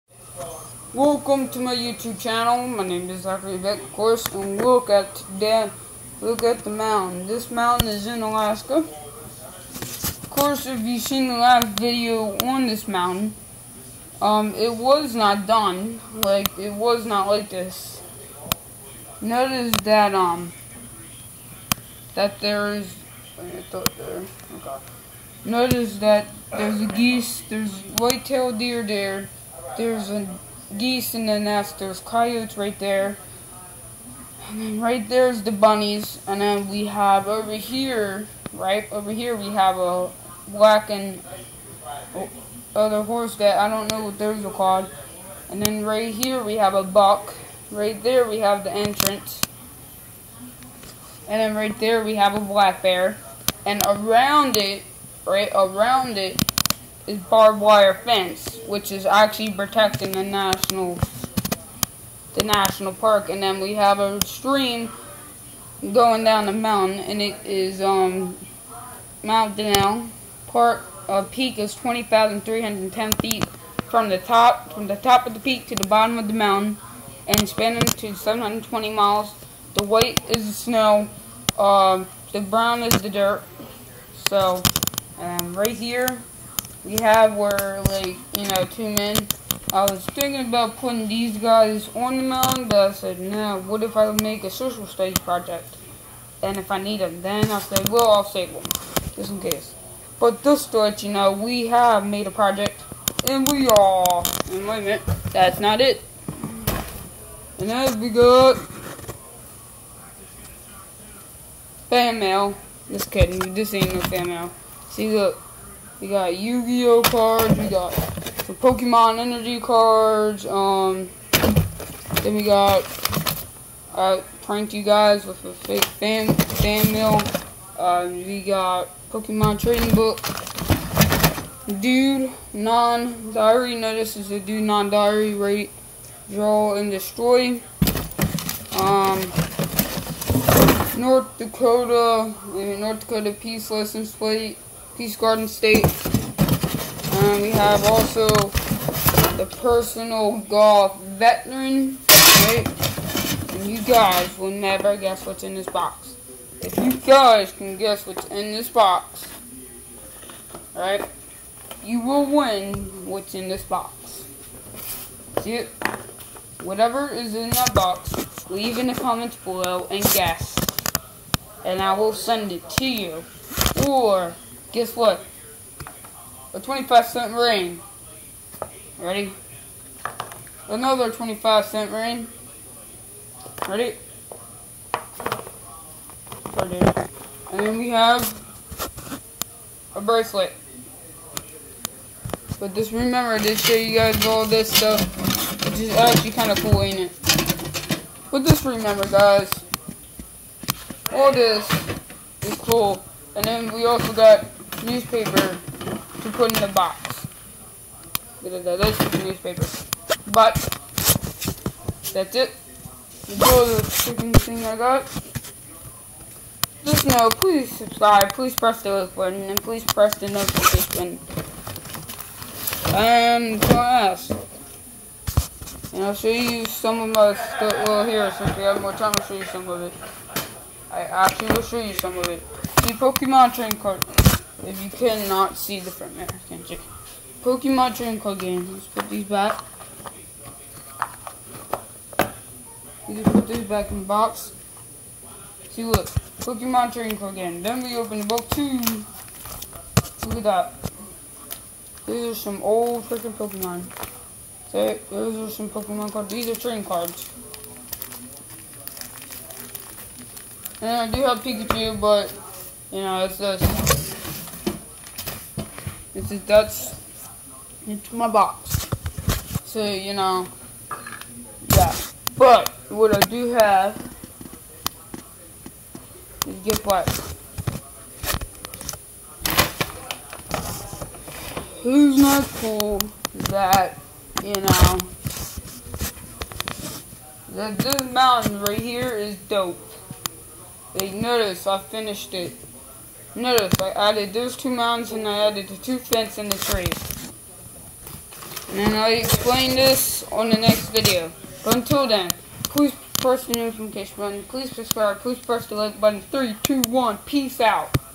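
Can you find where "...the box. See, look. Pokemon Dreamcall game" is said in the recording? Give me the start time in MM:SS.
04:04.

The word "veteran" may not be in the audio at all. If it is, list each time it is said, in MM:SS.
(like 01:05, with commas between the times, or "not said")
02:31.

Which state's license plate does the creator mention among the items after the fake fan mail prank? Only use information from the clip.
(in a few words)
North Dakota.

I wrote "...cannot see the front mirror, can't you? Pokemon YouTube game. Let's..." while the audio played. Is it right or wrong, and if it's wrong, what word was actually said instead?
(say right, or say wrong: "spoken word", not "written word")
wrong: "Dreamcall", not "YouTube".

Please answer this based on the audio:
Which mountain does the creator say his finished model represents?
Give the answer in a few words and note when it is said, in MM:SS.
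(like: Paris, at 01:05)
Mount Denali, at 01:09.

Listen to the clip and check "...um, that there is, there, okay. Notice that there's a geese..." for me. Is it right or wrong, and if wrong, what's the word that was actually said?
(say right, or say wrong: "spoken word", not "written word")
right.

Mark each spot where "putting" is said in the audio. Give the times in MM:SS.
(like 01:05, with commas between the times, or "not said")
01:30.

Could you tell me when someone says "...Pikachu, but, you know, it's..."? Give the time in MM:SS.
04:21.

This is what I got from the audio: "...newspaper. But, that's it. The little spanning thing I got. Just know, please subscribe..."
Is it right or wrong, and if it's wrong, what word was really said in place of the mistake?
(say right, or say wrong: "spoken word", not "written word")
wrong: "freaking", not "spanning".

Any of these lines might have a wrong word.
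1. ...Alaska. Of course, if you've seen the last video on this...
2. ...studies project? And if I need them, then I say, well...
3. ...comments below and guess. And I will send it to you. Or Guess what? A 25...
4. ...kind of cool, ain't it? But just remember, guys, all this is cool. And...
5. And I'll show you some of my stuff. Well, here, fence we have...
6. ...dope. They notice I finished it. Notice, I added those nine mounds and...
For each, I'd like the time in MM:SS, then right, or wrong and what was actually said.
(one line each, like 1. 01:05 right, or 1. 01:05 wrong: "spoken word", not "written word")
1. 00:08 right
2. 01:34 right
3. 02:48 right
4. 03:16 right
5. 03:45 wrong: "since", not "fence"
6. 04:49 wrong: "two", not "nine".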